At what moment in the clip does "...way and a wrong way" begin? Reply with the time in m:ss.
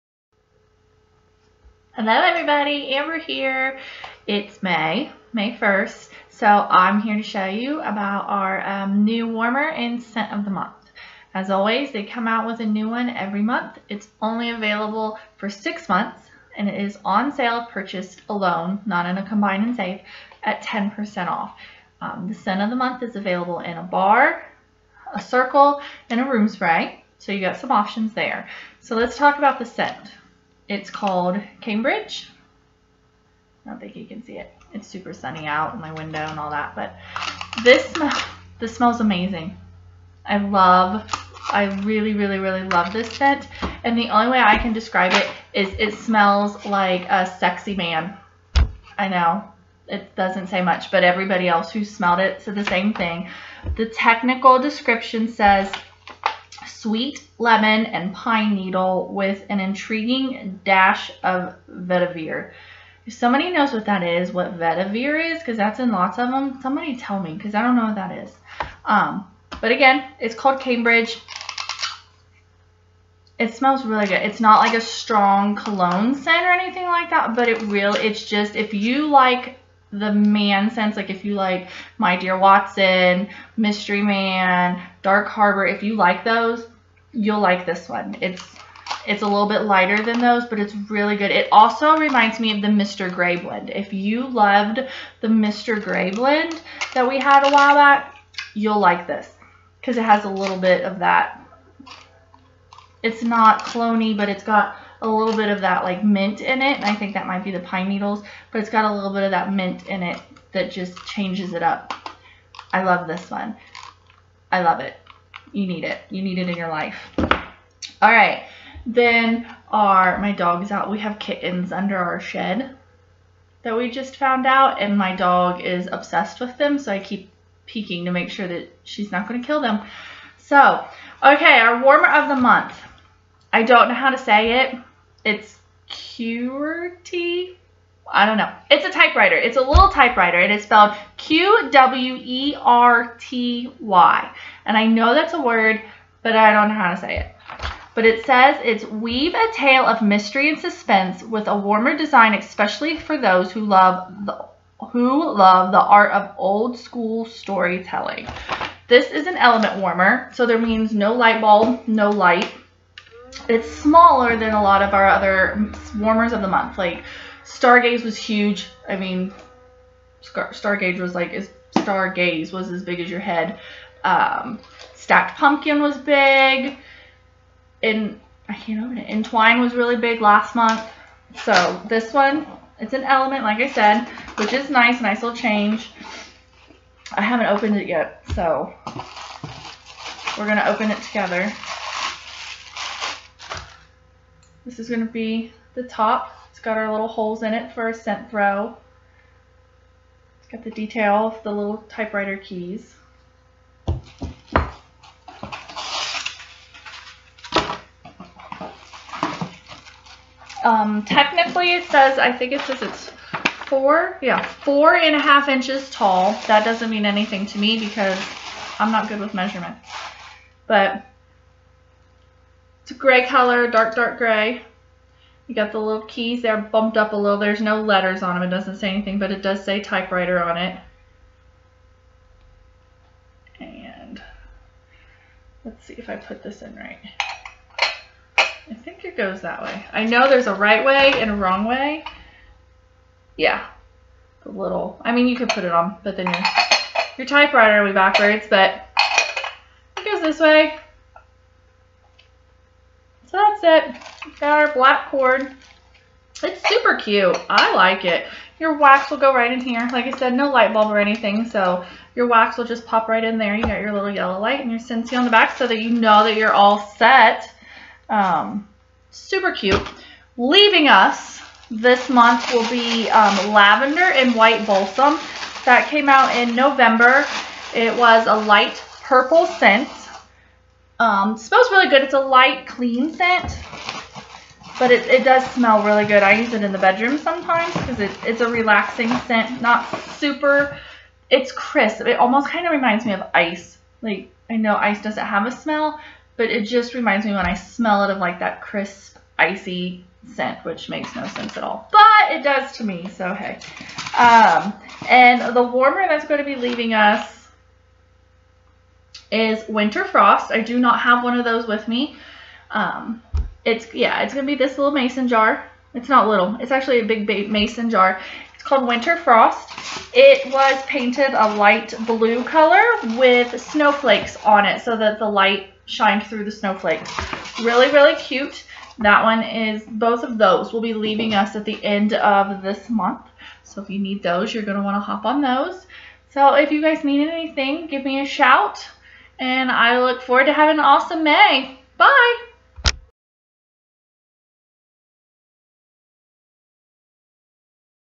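4:00.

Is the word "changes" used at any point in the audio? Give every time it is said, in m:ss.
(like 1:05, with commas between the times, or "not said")
1:51, 3:05.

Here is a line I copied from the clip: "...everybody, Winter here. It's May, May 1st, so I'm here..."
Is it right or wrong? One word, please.
wrong.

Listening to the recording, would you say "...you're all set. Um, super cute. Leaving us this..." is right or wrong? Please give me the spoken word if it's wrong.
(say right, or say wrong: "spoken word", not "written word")
right.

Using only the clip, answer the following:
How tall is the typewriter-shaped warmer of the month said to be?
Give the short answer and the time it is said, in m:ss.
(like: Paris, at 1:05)
4.5 inches, at 3:34.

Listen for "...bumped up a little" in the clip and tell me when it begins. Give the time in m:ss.
3:46.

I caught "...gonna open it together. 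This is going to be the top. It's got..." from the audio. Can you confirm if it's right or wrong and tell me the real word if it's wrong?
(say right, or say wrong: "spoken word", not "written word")
right.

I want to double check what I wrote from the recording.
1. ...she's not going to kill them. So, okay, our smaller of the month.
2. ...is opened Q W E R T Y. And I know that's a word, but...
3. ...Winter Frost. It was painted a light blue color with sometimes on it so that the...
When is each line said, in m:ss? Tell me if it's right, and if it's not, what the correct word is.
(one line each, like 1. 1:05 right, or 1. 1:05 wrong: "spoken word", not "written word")
1. 2:08 wrong: "warmer", not "smaller"
2. 2:20 wrong: "spelled", not "opened"
3. 5:18 wrong: "snowflakes", not "sometimes".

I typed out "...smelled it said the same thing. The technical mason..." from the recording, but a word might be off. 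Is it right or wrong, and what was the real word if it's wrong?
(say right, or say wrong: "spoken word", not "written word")
wrong: "description", not "mason".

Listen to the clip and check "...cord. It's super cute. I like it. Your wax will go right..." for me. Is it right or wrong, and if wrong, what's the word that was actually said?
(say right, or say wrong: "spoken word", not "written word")
right.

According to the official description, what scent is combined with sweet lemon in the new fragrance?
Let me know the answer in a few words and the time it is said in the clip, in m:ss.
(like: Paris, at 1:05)
pine needle, at 0:58.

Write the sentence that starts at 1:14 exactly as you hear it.
It's not like a strong cologne scent or anything like that, but it real.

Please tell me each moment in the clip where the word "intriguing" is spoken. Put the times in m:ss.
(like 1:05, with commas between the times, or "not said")
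0:59.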